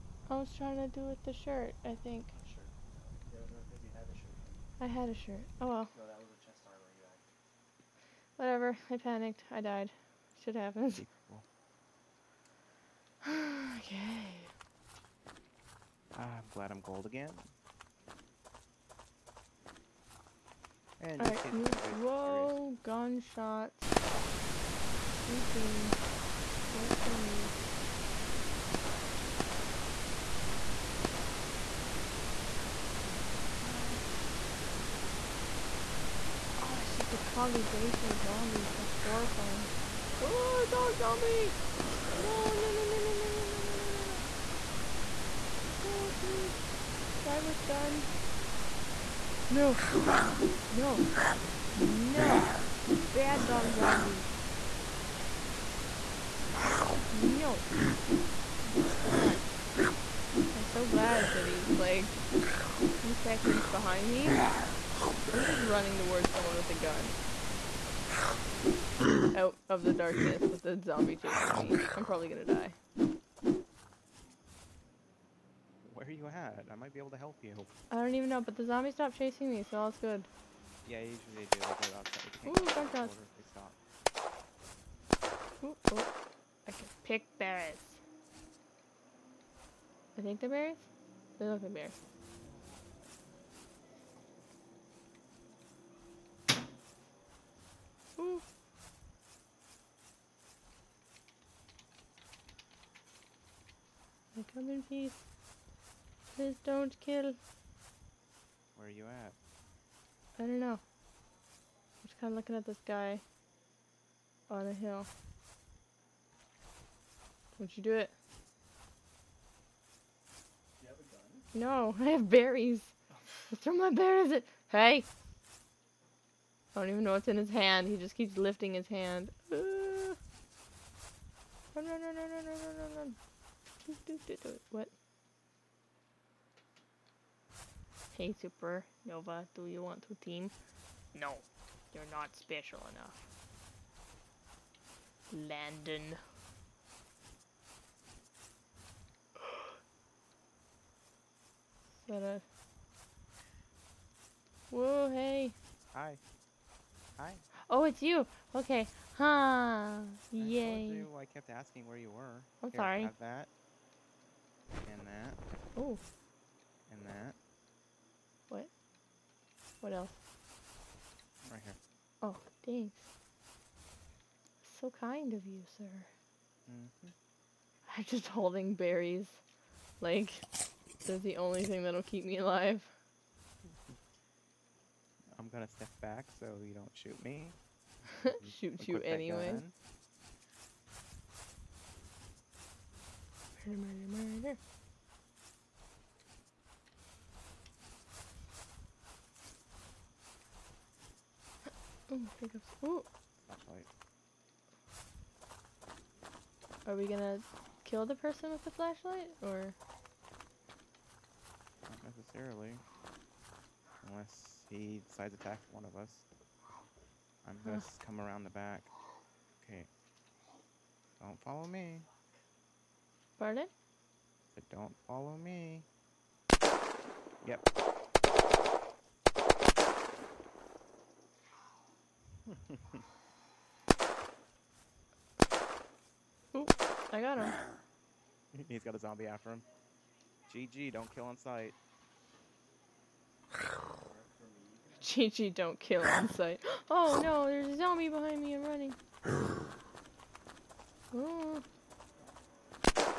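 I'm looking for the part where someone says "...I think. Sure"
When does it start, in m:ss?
0:01.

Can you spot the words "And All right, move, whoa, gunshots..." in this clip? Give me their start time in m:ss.
0:21.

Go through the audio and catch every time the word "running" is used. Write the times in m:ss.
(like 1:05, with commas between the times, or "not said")
1:05, 4:08.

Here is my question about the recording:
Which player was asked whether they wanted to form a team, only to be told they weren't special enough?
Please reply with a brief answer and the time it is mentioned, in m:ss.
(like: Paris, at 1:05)
Supernova, at 2:18.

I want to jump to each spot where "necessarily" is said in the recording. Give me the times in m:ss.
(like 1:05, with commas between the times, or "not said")
3:32.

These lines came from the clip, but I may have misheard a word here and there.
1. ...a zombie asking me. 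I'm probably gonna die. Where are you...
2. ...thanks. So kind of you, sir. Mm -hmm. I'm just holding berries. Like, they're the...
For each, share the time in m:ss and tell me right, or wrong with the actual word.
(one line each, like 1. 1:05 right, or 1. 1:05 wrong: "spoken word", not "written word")
1. 1:10 wrong: "chasing", not "asking"
2. 2:52 right.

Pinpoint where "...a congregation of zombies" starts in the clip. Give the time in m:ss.
0:37.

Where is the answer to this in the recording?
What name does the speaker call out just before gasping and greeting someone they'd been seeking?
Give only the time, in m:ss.
2:25.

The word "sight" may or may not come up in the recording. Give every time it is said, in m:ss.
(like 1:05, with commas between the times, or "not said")
4:01, 4:06.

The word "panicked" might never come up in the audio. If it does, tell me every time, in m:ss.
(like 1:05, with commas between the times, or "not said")
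0:08.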